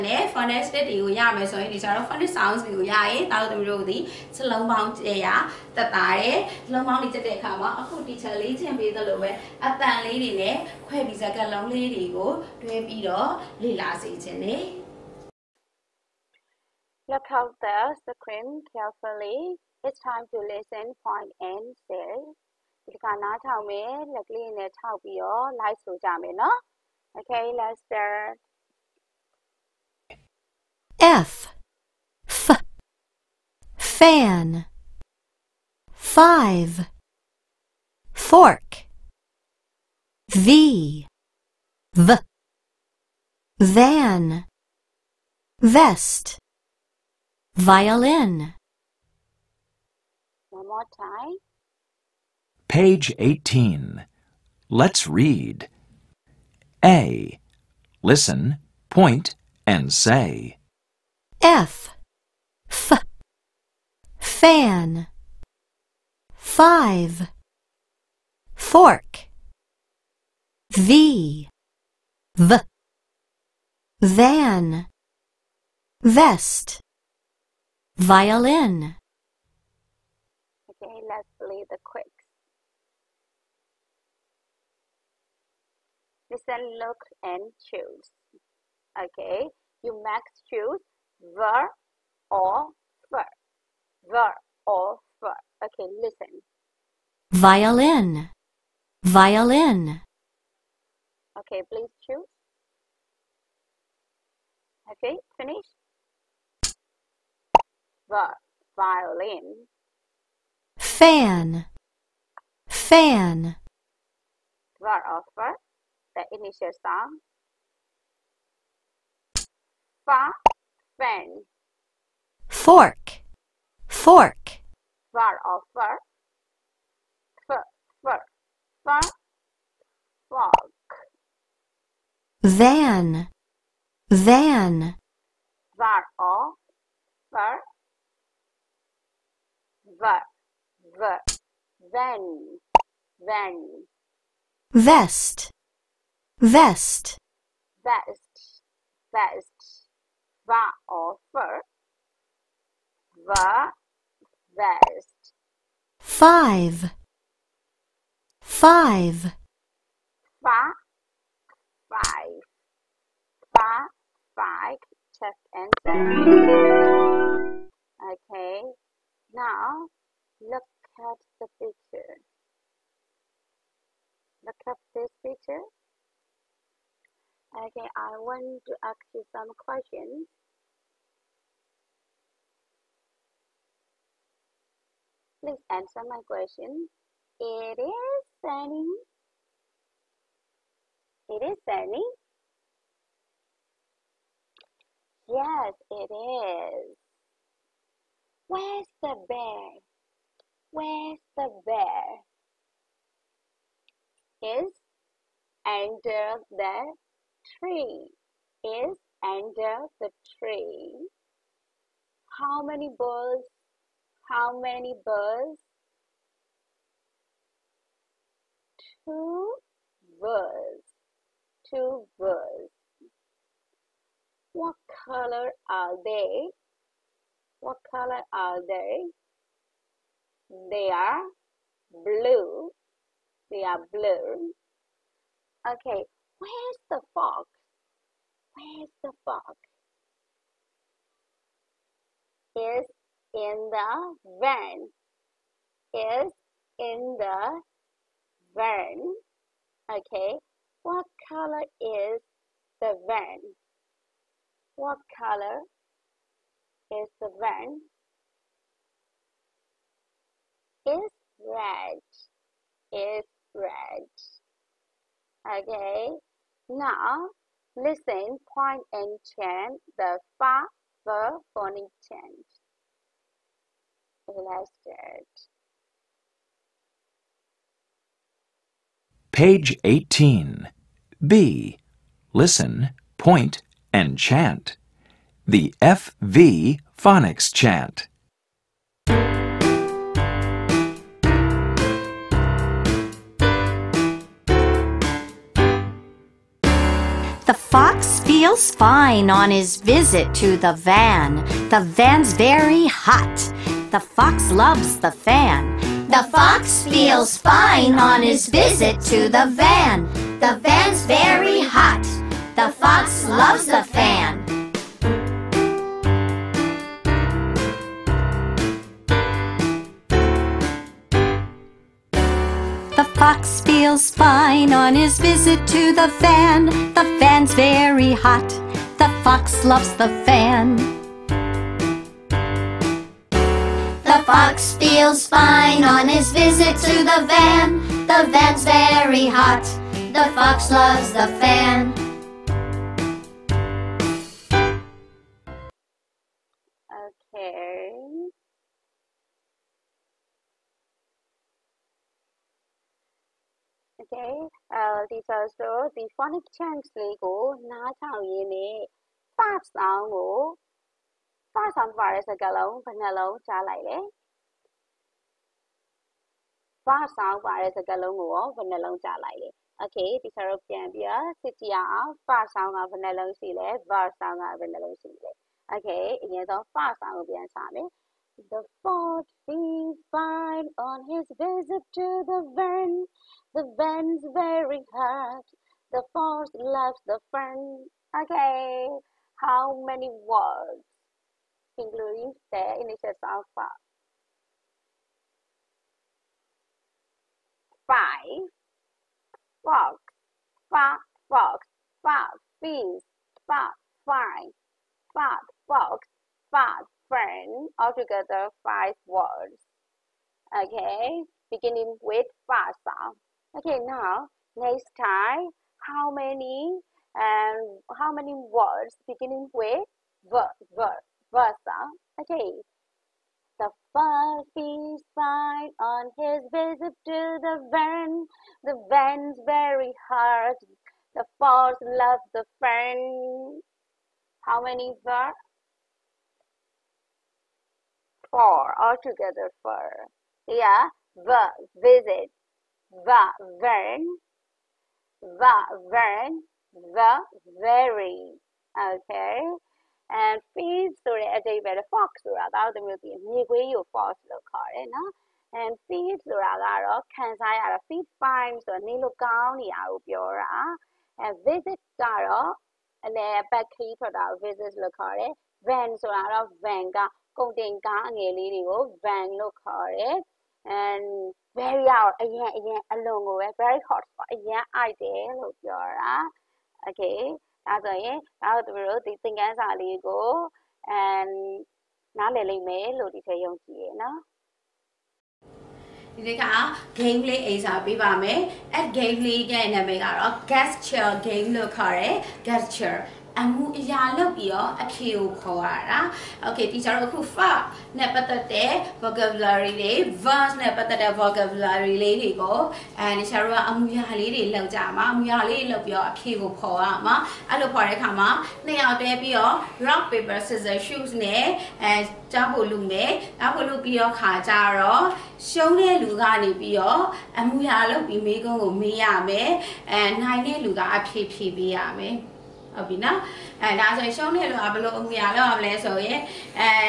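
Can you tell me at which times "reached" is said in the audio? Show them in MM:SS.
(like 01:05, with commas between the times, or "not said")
not said.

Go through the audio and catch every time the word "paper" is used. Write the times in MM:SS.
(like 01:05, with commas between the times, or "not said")
08:30.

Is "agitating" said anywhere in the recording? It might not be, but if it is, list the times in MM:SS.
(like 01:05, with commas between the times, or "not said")
not said.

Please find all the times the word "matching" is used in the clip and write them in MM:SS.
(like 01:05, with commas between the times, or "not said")
not said.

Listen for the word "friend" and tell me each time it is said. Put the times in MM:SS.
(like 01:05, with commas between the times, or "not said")
06:47, 07:12.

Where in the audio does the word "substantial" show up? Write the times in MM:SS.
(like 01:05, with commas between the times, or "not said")
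not said.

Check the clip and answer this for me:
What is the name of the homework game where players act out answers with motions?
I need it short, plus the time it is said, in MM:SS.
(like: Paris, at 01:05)
Gesture game, at 08:10.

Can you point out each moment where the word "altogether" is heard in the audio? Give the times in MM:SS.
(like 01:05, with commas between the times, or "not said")
06:47, 07:18.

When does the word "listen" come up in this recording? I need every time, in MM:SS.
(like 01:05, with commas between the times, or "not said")
00:20, 00:58, 01:26, 01:36, 04:27, 04:42.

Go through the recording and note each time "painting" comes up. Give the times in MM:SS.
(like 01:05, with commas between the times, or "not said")
not said.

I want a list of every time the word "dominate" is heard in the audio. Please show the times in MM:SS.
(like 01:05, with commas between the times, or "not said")
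not said.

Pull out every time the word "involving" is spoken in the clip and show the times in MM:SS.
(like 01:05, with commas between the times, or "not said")
not said.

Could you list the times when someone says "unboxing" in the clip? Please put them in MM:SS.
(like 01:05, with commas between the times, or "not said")
not said.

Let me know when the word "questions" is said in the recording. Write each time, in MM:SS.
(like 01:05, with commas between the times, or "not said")
02:59, 03:06.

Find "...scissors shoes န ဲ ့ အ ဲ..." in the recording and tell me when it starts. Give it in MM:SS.
08:30.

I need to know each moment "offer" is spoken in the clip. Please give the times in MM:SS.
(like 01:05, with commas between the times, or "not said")
02:30.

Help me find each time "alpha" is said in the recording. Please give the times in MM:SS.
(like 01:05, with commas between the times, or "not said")
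06:33.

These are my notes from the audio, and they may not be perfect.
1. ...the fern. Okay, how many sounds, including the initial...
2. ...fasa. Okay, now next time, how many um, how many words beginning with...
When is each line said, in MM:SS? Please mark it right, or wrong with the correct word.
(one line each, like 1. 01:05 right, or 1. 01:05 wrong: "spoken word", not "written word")
1. 06:27 wrong: "words", not "sounds"
2. 06:52 right.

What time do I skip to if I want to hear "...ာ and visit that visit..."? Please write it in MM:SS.
07:40.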